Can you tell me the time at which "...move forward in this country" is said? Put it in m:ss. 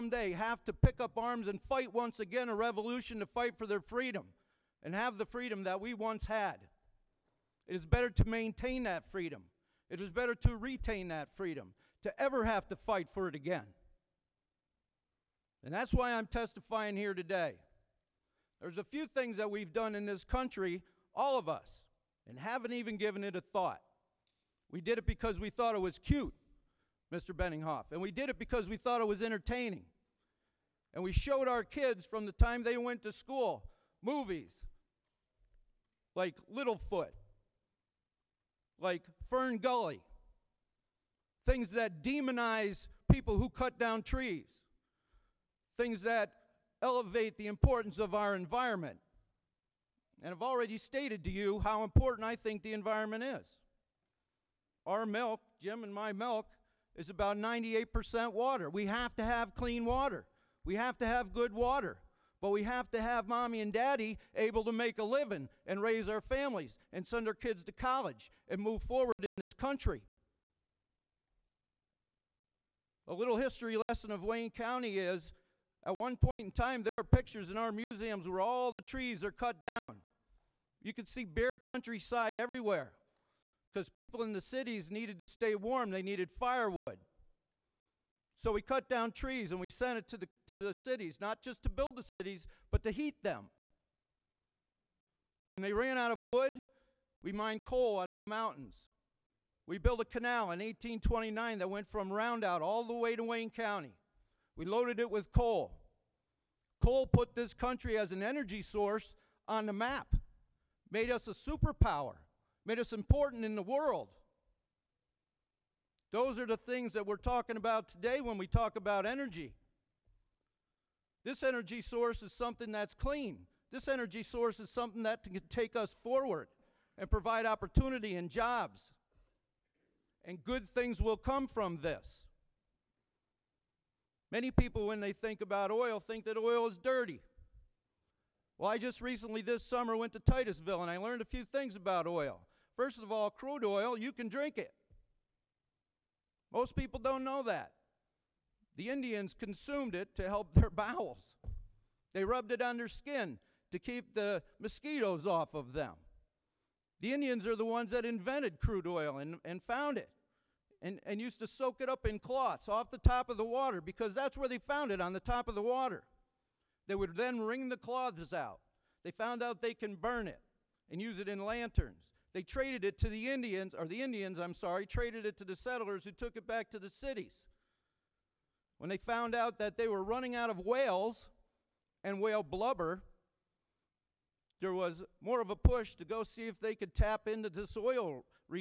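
1:08.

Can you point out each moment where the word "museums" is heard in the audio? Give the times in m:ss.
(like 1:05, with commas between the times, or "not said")
1:17.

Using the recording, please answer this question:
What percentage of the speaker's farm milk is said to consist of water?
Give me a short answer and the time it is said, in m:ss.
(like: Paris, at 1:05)
98%, at 0:57.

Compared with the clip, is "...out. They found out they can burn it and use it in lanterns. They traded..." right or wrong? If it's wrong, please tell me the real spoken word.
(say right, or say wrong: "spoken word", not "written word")
right.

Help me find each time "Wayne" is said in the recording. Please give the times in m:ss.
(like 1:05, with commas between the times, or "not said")
1:14, 1:43.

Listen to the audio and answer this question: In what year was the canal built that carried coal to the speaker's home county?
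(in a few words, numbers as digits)
1829.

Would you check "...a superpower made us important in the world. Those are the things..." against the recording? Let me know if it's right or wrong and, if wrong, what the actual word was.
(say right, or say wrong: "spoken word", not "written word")
right.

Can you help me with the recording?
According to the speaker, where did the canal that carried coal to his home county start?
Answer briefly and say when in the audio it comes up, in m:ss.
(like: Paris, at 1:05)
Rondout, at 1:42.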